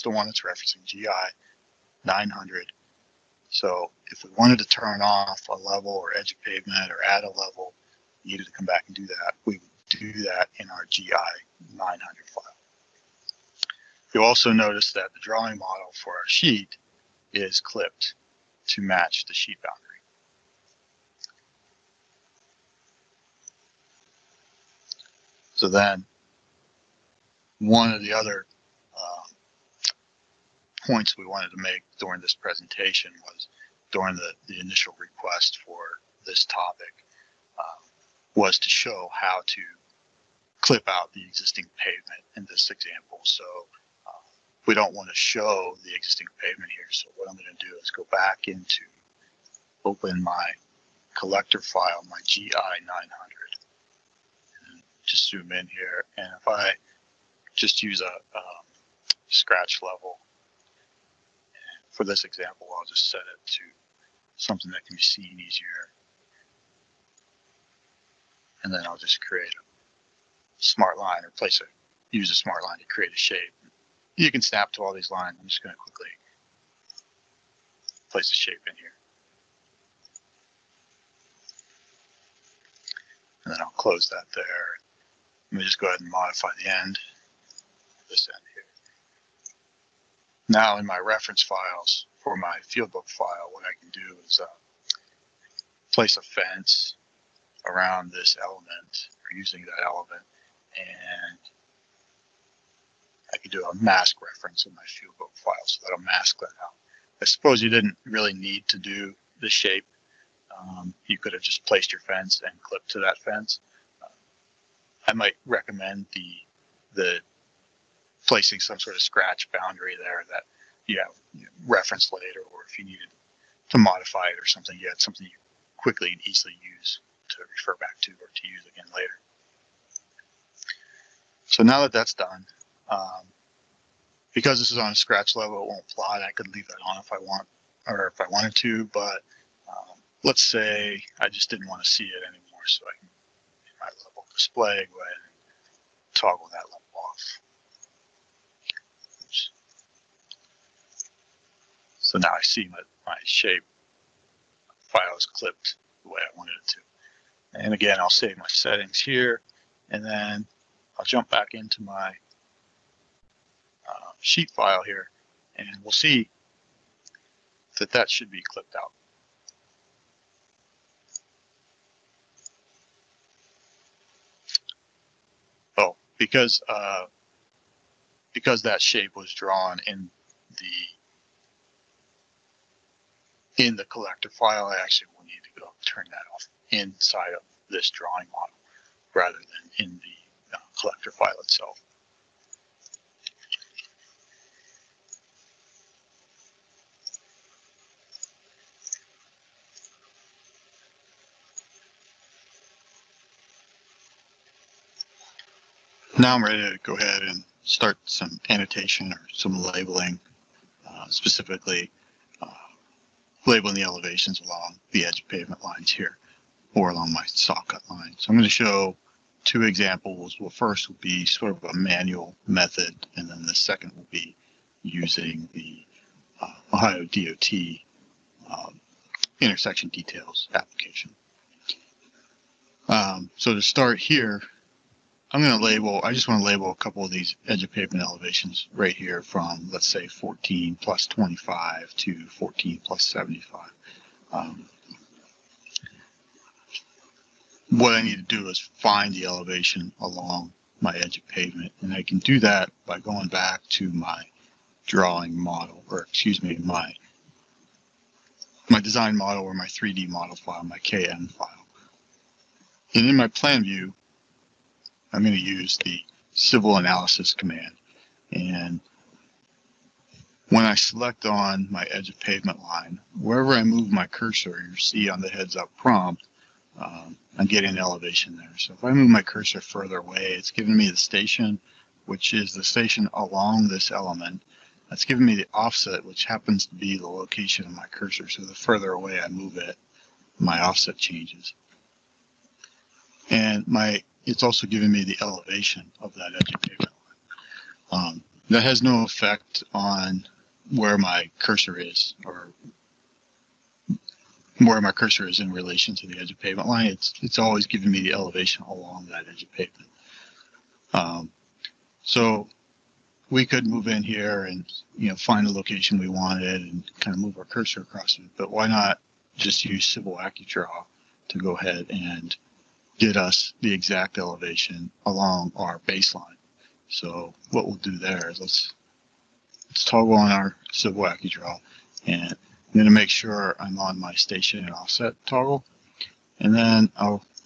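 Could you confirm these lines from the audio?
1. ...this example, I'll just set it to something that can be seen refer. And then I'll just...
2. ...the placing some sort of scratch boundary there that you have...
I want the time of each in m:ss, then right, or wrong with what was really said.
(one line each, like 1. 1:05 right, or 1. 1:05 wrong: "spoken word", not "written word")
1. 1:02 wrong: "easier", not "refer"
2. 1:56 right.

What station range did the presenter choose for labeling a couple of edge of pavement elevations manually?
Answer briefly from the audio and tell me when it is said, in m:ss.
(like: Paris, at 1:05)
14+25 to 14+75, at 4:00.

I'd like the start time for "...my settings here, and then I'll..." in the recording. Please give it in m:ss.
2:38.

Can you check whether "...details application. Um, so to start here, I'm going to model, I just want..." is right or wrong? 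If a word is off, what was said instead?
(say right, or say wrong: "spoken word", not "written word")
wrong: "label", not "model".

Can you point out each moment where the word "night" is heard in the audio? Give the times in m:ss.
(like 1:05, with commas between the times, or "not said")
not said.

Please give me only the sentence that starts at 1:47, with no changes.
I suppose you didn't really need to do the shape.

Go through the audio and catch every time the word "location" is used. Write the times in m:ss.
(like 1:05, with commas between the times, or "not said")
4:47, 5:15.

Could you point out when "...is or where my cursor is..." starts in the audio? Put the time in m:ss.
5:01.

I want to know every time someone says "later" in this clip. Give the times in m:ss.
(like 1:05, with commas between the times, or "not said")
2:02, 2:08.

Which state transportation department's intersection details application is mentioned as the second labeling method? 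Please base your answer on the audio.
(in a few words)
Ohio DOT.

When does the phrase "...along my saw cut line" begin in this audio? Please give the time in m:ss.
3:36.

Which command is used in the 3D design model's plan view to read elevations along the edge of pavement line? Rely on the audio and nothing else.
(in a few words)
civil analysis.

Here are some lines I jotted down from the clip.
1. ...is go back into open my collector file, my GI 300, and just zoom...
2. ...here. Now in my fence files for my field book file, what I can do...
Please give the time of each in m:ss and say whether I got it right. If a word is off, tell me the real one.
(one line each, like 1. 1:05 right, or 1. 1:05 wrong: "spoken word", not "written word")
1. 0:47 wrong: "900", not "300"
2. 1:28 wrong: "reference", not "fence".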